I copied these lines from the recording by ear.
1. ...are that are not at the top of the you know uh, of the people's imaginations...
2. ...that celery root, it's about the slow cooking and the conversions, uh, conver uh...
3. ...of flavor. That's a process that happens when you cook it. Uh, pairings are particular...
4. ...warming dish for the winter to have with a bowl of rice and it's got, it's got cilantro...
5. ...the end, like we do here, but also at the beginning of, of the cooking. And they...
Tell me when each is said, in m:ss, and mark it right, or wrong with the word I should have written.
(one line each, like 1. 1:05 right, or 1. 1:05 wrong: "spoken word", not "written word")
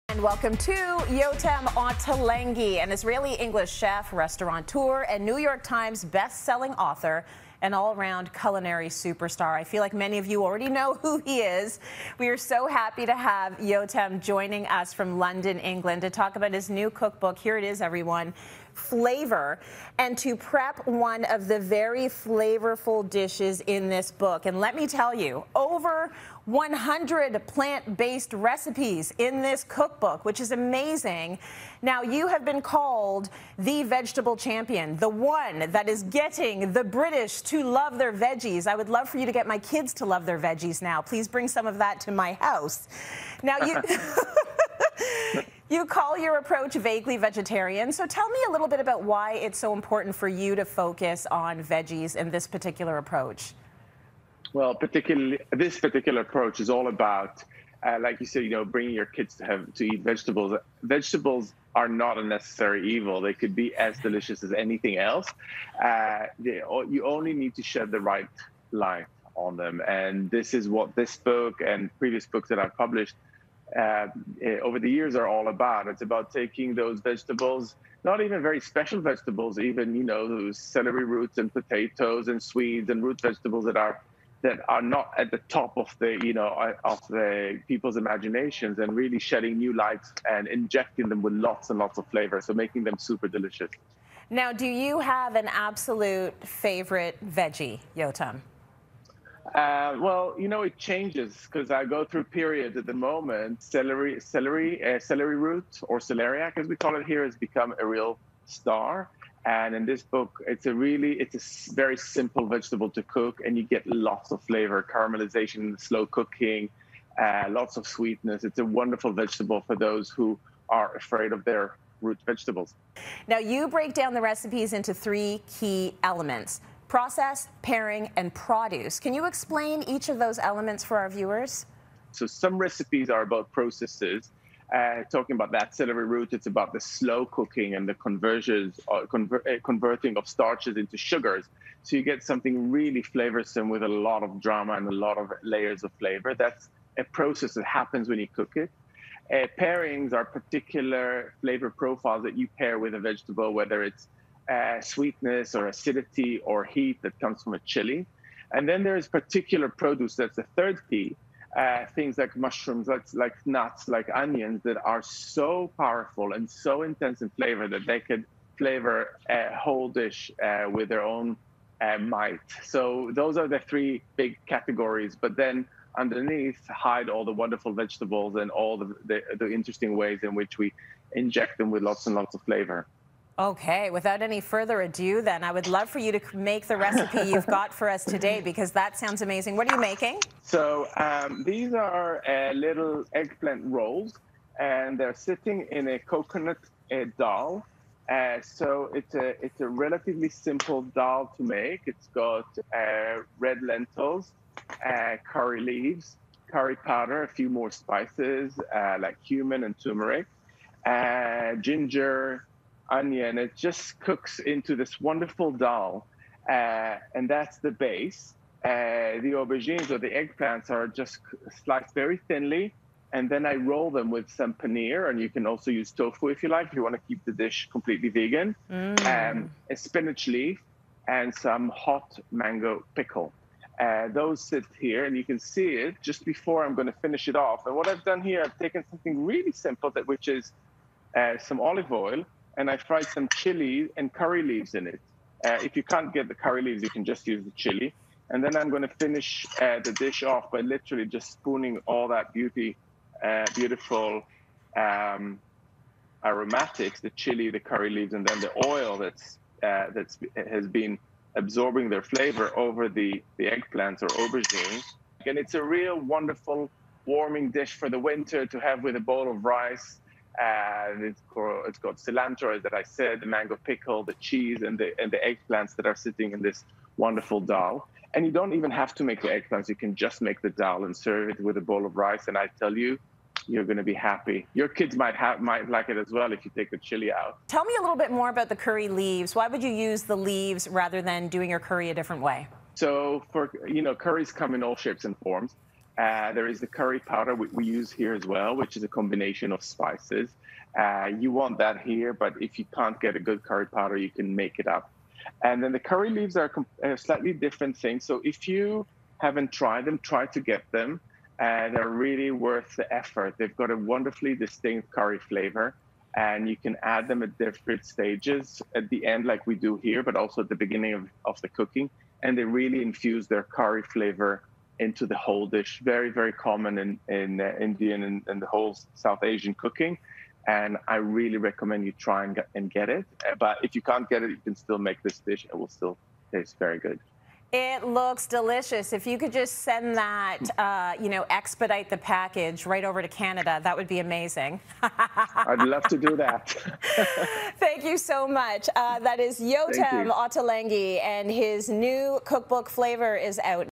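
1. 1:23 right
2. 2:15 right
3. 2:25 right
4. 4:27 right
5. 5:18 right.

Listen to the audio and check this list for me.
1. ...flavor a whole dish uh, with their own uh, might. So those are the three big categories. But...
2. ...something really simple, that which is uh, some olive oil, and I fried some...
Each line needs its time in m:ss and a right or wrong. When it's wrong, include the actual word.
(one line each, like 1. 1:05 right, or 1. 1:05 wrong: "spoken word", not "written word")
1. 2:48 right
2. 3:58 right.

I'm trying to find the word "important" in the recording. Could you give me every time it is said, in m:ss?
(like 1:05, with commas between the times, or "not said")
0:49.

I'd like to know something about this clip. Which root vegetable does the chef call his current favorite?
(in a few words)
celeriac.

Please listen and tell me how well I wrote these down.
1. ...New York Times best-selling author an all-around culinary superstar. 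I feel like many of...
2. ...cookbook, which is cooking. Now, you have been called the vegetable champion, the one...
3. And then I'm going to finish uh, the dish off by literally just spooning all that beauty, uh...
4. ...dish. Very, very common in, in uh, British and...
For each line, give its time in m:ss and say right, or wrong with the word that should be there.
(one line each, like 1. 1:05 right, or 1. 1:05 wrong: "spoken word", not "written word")
1. 0:05 right
2. 0:29 wrong: "amazing", not "cooking"
3. 4:08 right
4. 5:25 wrong: "Indian", not "British".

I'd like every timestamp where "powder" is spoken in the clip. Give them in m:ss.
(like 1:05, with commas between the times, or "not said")
3:26, 4:56, 5:03.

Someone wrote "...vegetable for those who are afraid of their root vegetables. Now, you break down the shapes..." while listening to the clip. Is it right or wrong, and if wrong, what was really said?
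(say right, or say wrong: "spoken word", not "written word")
wrong: "recipes", not "shapes".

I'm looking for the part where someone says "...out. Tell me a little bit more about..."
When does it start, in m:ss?
4:47.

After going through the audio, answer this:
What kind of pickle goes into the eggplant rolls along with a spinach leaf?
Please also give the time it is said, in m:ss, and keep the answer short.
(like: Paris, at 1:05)
hot mango pickle, at 3:51.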